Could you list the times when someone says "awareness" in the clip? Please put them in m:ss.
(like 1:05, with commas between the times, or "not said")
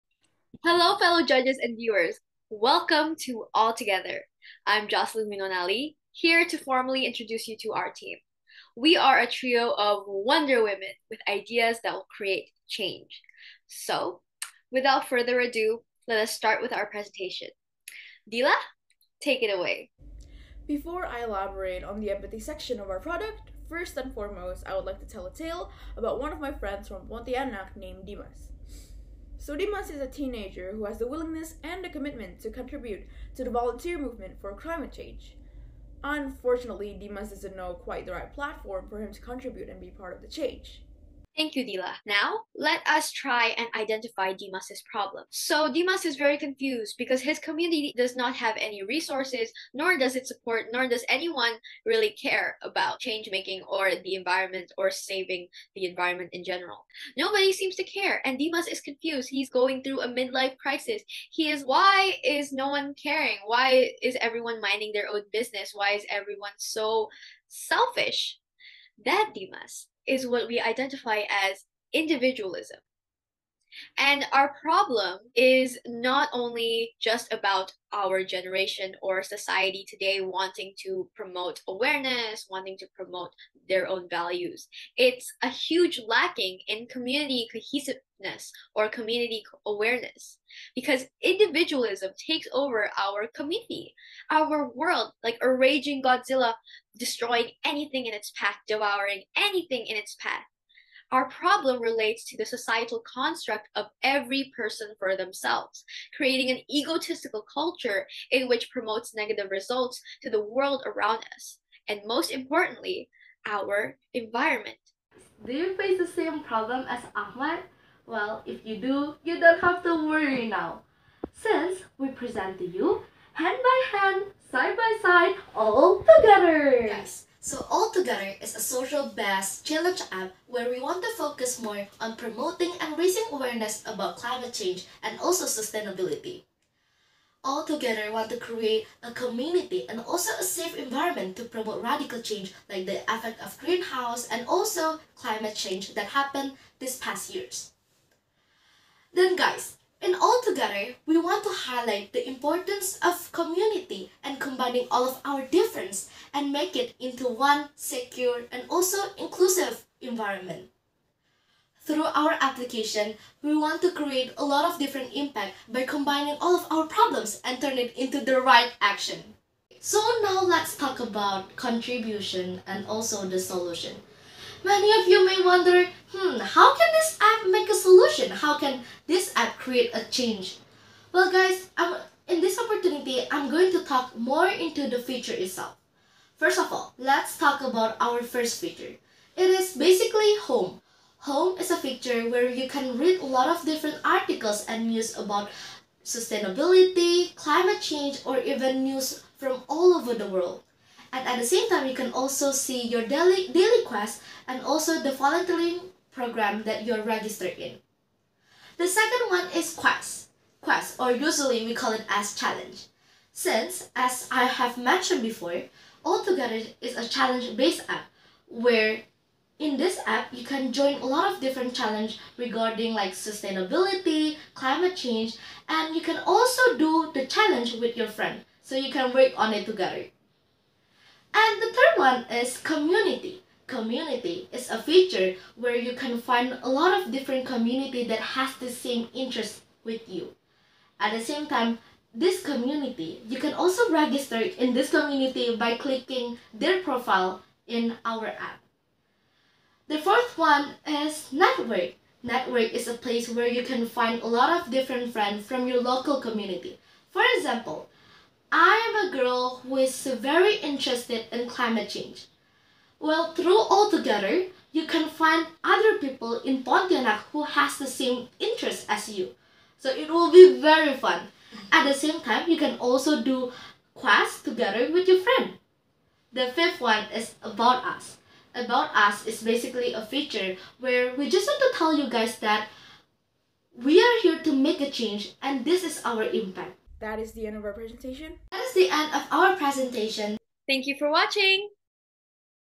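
1:21, 1:29, 2:13.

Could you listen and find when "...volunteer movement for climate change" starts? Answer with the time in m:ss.
0:33.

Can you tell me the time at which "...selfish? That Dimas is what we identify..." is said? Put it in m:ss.
1:07.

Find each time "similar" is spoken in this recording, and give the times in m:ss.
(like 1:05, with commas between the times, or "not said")
not said.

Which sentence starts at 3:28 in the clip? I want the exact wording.
The second one is quest, quest or usually we call it as challenge.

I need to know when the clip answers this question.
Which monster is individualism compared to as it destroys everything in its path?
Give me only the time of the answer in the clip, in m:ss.
1:36.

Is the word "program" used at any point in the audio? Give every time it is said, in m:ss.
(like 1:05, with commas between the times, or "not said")
3:26.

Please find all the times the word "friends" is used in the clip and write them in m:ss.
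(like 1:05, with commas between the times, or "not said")
0:26, 3:48, 4:15, 4:35.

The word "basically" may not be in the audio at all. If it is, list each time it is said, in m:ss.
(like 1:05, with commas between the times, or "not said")
3:09, 4:39.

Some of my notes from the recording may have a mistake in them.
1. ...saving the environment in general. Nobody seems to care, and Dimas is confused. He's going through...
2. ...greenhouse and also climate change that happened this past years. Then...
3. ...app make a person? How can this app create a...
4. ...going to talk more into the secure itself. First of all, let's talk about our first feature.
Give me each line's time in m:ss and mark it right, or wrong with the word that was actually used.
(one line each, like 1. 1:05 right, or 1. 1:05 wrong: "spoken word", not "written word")
1. 0:54 right
2. 2:23 right
3. 2:57 wrong: "solution", not "person"
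4. 3:03 wrong: "feature", not "secure".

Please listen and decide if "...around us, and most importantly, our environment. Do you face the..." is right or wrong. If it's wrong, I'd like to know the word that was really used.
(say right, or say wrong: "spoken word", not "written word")
right.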